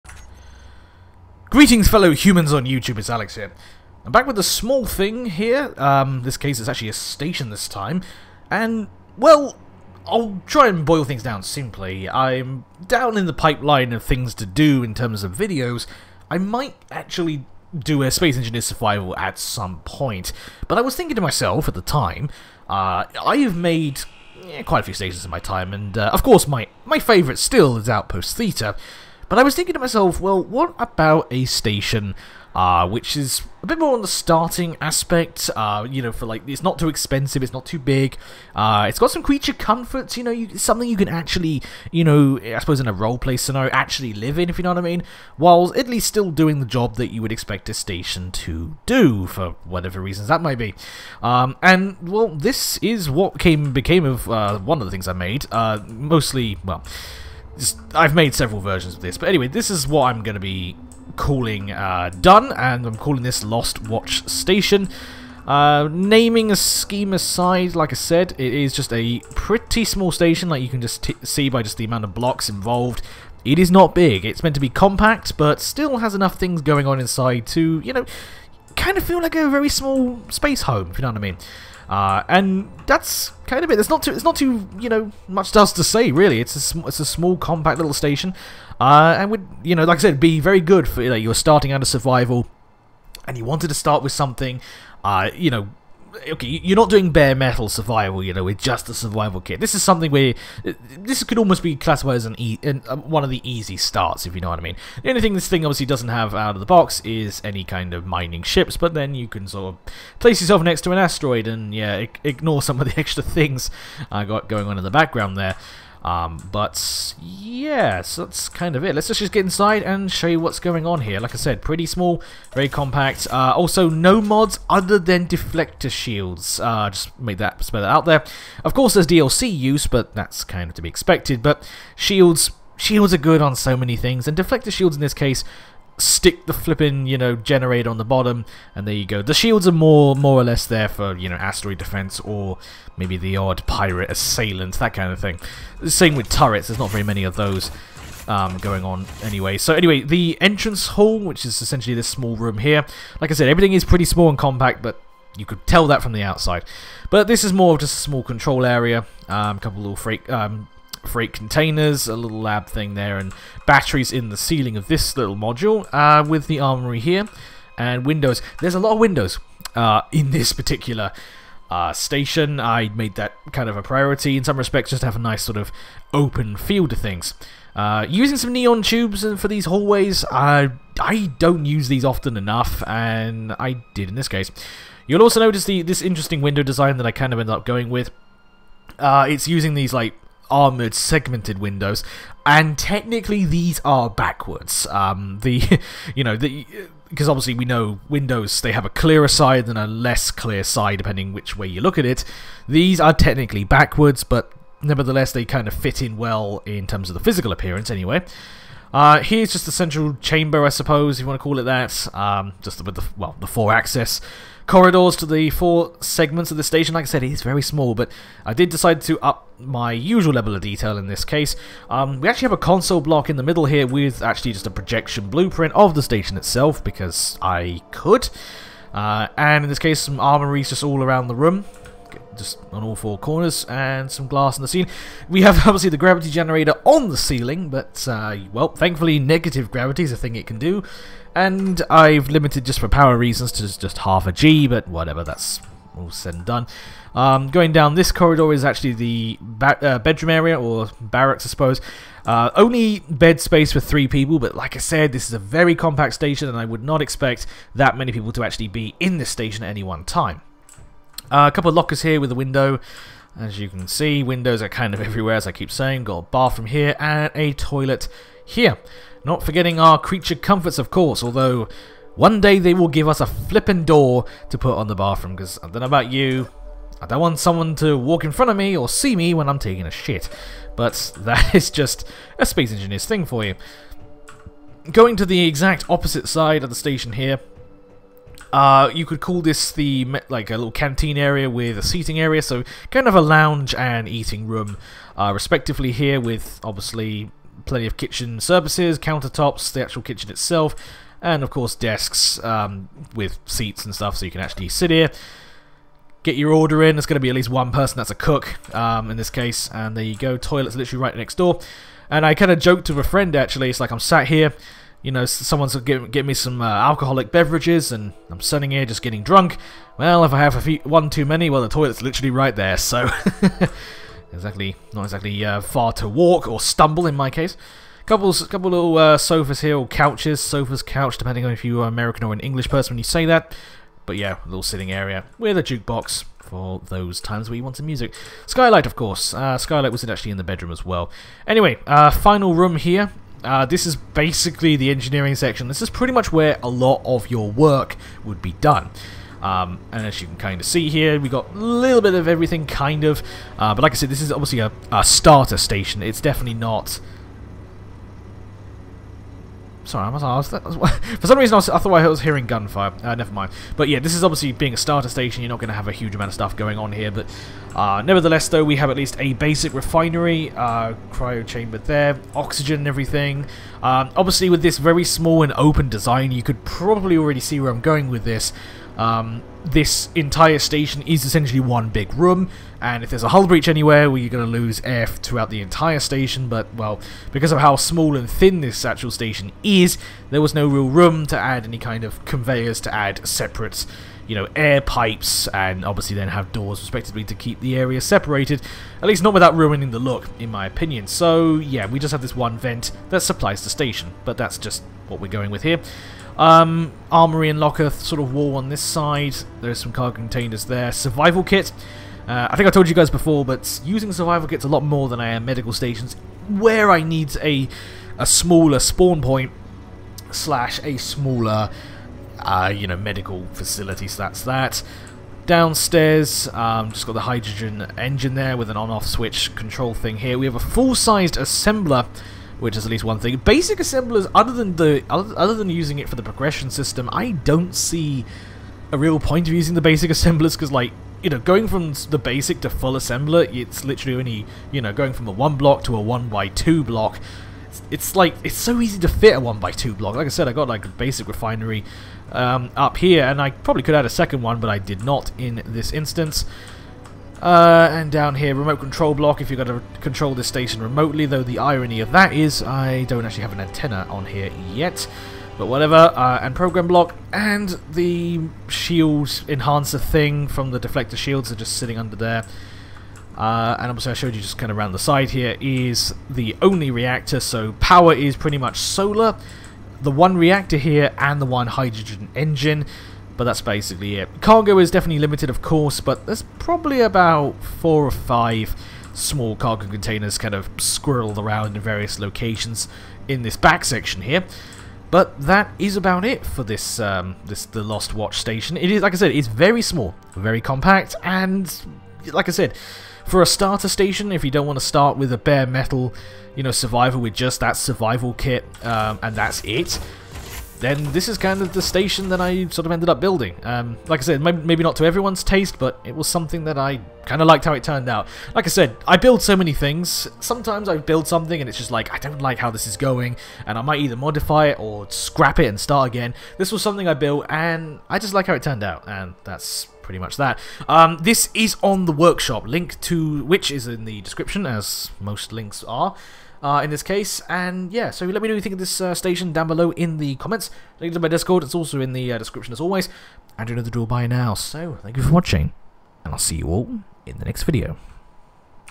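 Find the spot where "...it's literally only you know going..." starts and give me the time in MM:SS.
07:23.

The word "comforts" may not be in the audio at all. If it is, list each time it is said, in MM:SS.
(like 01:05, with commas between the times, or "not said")
00:39, 04:30.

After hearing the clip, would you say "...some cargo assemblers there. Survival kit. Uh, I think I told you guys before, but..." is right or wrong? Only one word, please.
wrong.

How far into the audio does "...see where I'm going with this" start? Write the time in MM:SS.
06:17.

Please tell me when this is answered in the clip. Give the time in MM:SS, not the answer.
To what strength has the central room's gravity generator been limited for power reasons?
04:03.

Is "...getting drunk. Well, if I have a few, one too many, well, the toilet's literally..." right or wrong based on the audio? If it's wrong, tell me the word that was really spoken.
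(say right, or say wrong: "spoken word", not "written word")
right.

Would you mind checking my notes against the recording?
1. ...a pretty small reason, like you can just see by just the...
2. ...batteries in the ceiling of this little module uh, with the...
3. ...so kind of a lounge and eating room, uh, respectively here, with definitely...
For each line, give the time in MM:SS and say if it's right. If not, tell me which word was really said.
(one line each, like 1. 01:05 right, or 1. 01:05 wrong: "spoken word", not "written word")
1. 01:08 wrong: "station", not "reason"
2. 02:43 right
3. 04:52 wrong: "obviously", not "definitely".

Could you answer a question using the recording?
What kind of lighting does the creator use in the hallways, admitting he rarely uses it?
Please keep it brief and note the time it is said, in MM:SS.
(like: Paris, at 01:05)
Neon tubes, at 02:58.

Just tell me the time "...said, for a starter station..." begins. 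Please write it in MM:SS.
08:22.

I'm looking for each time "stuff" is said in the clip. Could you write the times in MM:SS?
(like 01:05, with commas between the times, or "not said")
05:03, 06:06.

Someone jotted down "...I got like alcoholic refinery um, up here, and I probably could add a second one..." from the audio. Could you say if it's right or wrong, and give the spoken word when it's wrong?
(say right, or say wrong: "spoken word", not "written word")
wrong: "basic", not "alcoholic".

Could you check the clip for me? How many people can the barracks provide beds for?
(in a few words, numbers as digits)
3.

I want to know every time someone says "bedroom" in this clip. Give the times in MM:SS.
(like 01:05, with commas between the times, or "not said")
04:09, 05:40.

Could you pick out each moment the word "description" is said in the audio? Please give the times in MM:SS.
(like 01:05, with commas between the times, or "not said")
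08:54, 09:02.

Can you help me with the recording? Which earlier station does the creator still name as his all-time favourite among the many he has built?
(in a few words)
Outpost Theta.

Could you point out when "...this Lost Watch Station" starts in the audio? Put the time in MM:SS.
01:03.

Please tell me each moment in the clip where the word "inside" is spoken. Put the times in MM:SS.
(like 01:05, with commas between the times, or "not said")
01:16, 01:59.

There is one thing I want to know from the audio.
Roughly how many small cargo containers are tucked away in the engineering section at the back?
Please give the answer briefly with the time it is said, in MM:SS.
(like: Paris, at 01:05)
4 or 5, at 08:07.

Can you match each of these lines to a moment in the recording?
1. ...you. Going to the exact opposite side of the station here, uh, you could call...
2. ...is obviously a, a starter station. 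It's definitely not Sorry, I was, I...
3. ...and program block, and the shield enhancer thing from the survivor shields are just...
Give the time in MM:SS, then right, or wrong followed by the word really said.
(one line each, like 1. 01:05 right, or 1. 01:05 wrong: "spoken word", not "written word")
1. 04:43 right
2. 05:54 right
3. 07:46 wrong: "deflector", not "survivor".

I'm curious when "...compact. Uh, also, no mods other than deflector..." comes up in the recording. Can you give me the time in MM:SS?
02:02.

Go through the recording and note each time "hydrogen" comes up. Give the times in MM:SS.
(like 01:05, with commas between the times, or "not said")
07:07, 08:01.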